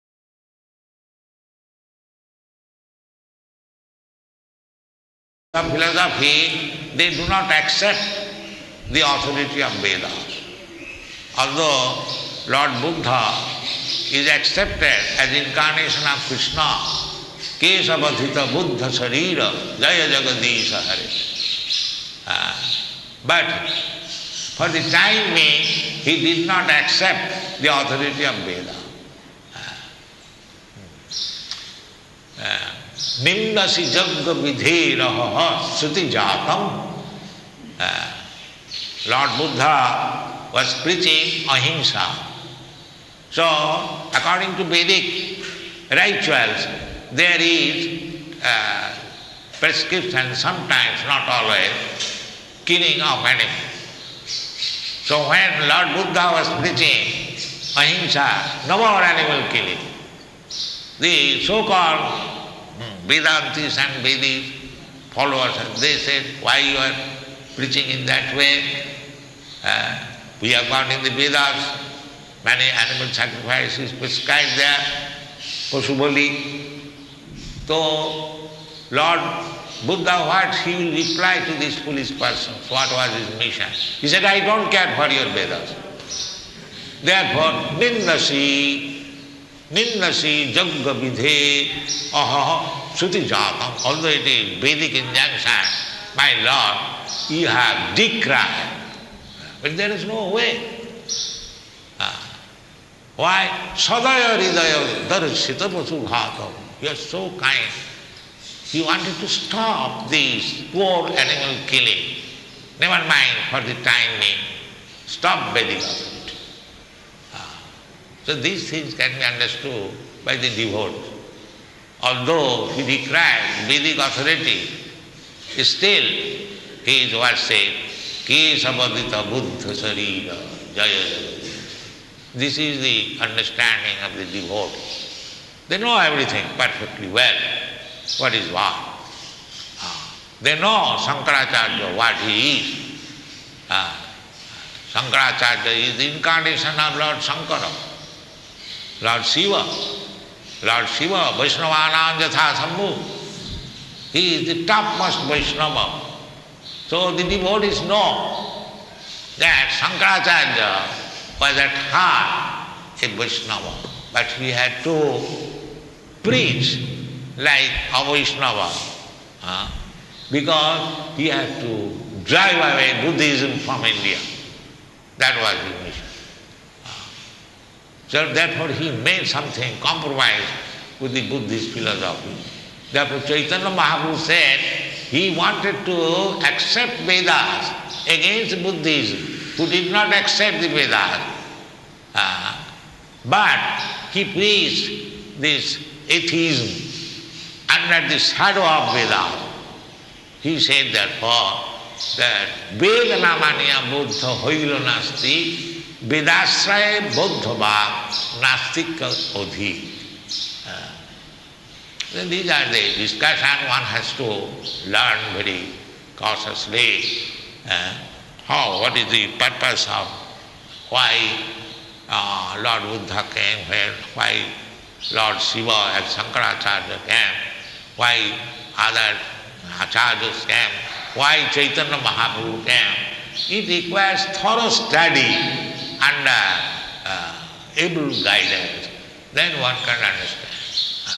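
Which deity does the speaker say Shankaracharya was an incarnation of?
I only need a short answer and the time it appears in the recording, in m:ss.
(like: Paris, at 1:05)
Lord Shankara, at 2:26.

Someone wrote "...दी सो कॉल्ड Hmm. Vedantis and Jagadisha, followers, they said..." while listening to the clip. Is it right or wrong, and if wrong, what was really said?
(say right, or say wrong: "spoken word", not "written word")
wrong: "Vedis", not "Jagadisha".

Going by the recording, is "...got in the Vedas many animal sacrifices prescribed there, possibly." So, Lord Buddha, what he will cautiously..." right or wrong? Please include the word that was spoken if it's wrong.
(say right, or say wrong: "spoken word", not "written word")
wrong: "reply", not "cautiously".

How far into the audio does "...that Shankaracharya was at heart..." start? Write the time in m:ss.
2:39.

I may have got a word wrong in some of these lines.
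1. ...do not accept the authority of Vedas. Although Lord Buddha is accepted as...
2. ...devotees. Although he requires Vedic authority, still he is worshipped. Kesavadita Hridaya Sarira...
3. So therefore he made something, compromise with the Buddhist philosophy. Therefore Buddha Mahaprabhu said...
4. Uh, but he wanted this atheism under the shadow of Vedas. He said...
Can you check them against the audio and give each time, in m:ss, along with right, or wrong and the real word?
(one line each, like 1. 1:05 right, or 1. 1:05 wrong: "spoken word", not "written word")
1. 0:07 right
2. 2:00 wrong: "Buddha", not "Hridaya"
3. 2:58 wrong: "Chaitanya", not "Buddha"
4. 3:12 wrong: "preached", not "wanted".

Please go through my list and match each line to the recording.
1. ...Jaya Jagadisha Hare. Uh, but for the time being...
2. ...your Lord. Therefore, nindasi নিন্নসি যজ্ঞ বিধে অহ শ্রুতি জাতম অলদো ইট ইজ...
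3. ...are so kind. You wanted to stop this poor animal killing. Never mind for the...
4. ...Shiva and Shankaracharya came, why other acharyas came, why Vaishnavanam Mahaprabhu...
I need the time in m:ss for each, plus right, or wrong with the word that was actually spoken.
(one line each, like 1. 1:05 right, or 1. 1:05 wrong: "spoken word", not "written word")
1. 0:19 right
2. 1:25 wrong: "Vedas", not "Lord"
3. 1:46 right
4. 3:45 wrong: "Chaitanya", not "Vaishnavanam".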